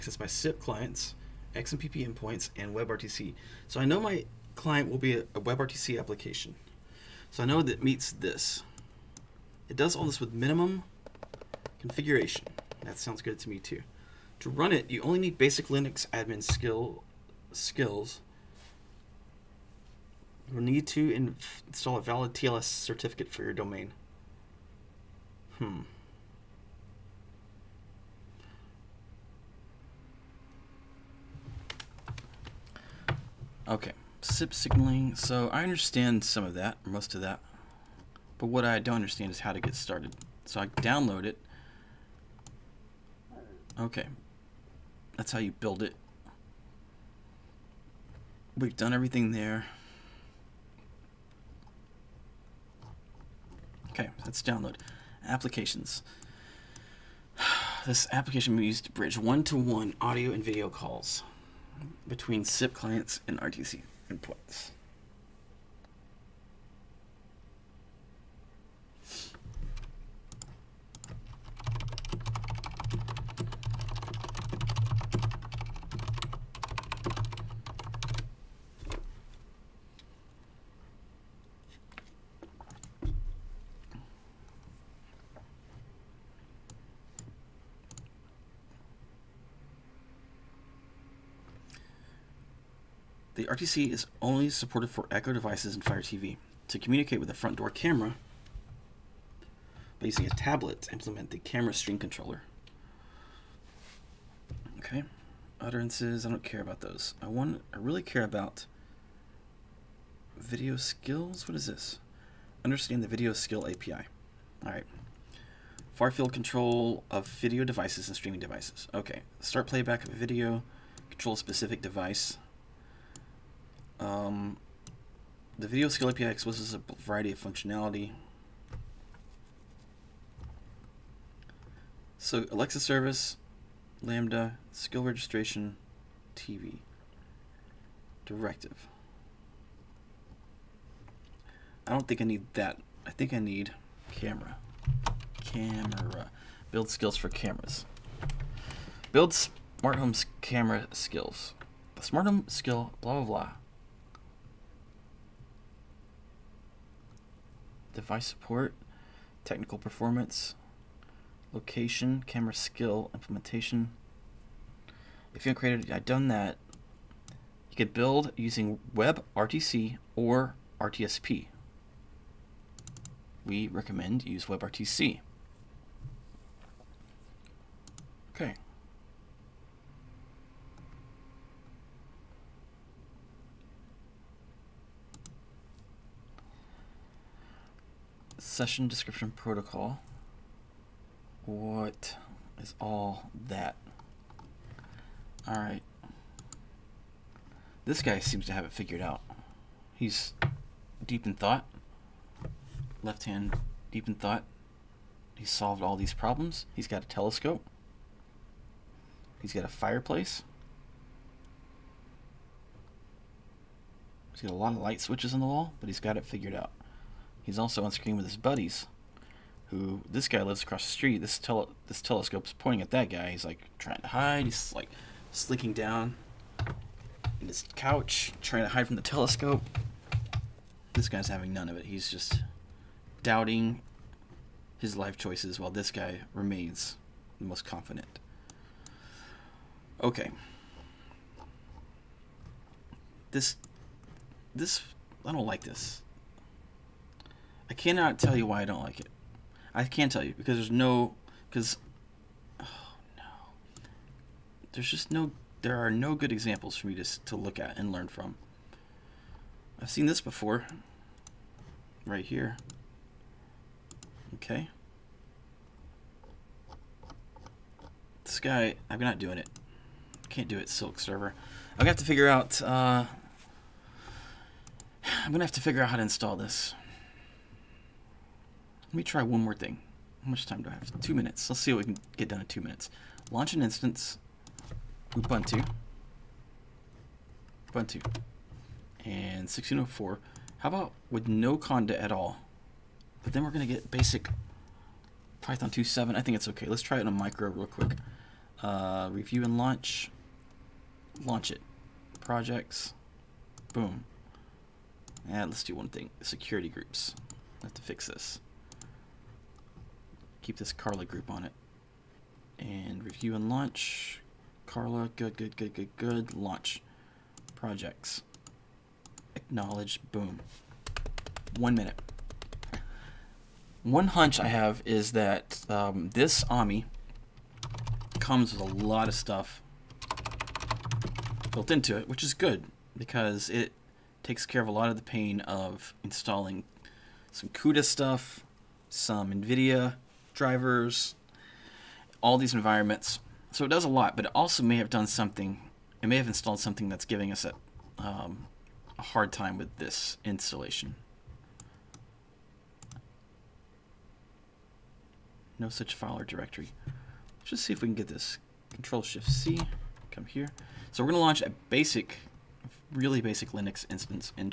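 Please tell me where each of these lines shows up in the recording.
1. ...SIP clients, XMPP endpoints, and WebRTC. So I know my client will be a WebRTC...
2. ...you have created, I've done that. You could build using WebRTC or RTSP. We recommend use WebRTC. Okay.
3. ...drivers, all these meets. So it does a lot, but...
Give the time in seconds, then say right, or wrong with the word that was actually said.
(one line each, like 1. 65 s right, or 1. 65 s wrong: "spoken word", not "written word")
1. 0 s right
2. 165 s right
3. 340 s wrong: "environments", not "meets".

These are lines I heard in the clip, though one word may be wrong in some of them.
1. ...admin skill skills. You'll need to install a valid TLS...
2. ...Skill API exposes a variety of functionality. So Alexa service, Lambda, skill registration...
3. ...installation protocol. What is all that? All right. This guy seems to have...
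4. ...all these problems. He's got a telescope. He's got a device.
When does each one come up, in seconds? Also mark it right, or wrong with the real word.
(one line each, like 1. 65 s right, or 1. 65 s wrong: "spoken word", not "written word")
1. 16 s right
2. 125 s right
3. 188 s wrong: "description", not "installation"
4. 205 s wrong: "fireplace", not "device".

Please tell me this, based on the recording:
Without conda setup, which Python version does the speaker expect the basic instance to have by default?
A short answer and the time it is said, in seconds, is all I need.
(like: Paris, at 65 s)
Python 2.7, at 295 s.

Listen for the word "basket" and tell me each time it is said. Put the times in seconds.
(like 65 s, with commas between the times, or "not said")
not said.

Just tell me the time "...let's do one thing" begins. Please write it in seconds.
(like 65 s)
305 s.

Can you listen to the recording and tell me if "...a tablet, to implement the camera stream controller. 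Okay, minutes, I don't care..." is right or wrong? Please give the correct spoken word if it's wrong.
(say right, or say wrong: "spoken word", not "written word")
wrong: "utterances", not "minutes".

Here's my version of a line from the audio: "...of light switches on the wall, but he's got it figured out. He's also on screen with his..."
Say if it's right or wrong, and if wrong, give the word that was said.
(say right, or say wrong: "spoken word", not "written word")
right.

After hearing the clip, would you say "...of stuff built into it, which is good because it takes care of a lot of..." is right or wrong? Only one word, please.
right.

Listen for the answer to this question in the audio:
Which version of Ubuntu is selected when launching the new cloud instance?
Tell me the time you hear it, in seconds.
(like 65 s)
289 s.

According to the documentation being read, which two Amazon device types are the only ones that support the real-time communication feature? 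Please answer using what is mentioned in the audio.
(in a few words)
Echo devices and Fire TV.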